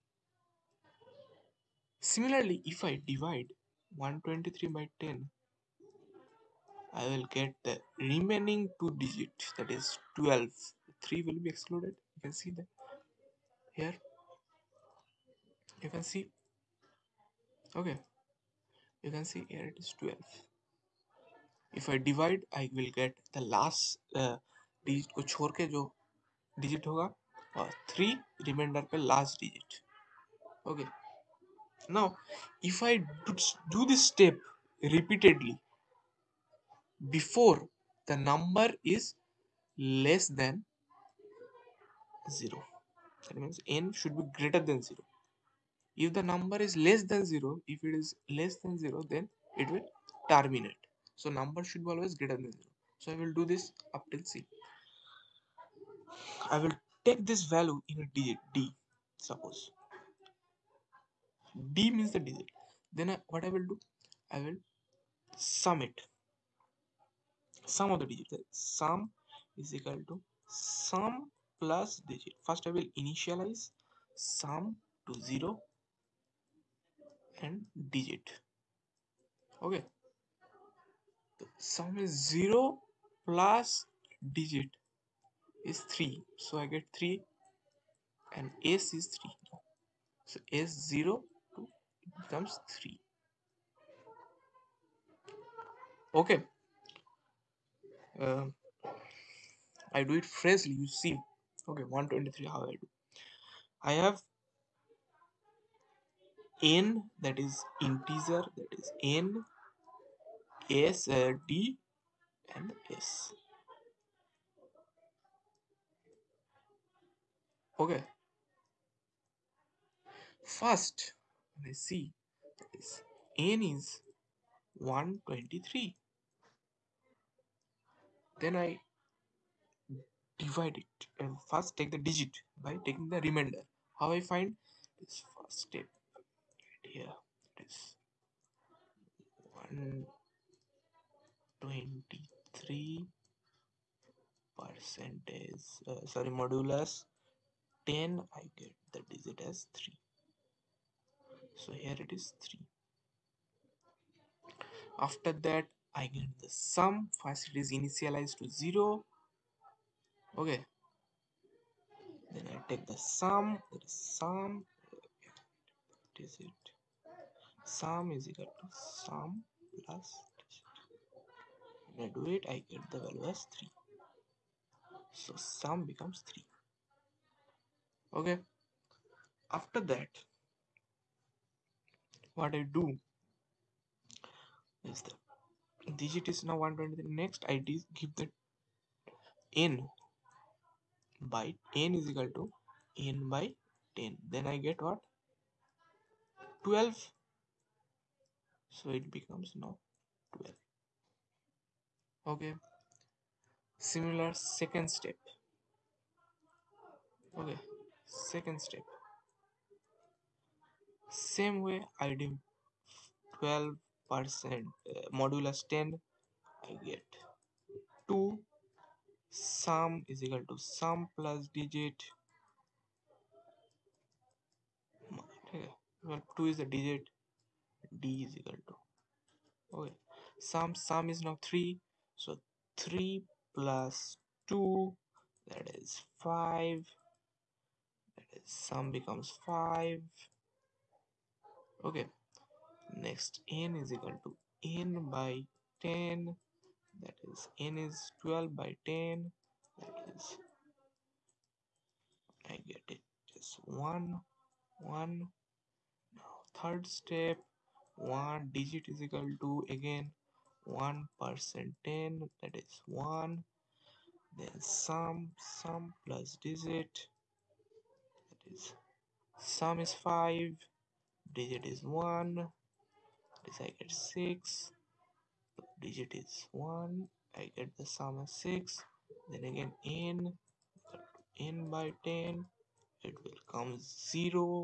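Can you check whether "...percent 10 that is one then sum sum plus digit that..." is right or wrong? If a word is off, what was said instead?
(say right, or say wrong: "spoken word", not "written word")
right.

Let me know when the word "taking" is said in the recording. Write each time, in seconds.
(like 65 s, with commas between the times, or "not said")
132 s.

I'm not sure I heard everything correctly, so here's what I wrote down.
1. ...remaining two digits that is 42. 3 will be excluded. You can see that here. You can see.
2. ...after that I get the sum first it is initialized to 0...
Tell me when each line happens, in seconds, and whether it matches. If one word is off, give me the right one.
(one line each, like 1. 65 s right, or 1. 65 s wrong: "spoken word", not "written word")
1. 7 s wrong: "12", not "42"
2. 155 s right.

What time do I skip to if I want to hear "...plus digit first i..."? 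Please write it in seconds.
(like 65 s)
71 s.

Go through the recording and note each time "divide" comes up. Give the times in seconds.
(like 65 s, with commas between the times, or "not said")
3 s, 21 s, 130 s.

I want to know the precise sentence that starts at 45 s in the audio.
If the number is less than 0, if it is less than 0, then it will terminate.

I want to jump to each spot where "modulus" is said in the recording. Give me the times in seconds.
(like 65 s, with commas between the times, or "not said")
146 s, 215 s.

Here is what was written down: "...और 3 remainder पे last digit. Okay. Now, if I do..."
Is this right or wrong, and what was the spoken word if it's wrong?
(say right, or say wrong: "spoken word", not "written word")
right.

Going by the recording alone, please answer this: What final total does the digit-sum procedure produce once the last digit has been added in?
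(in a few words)
6.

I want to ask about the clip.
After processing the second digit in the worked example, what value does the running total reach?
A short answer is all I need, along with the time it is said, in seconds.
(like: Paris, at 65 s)
5, at 238 s.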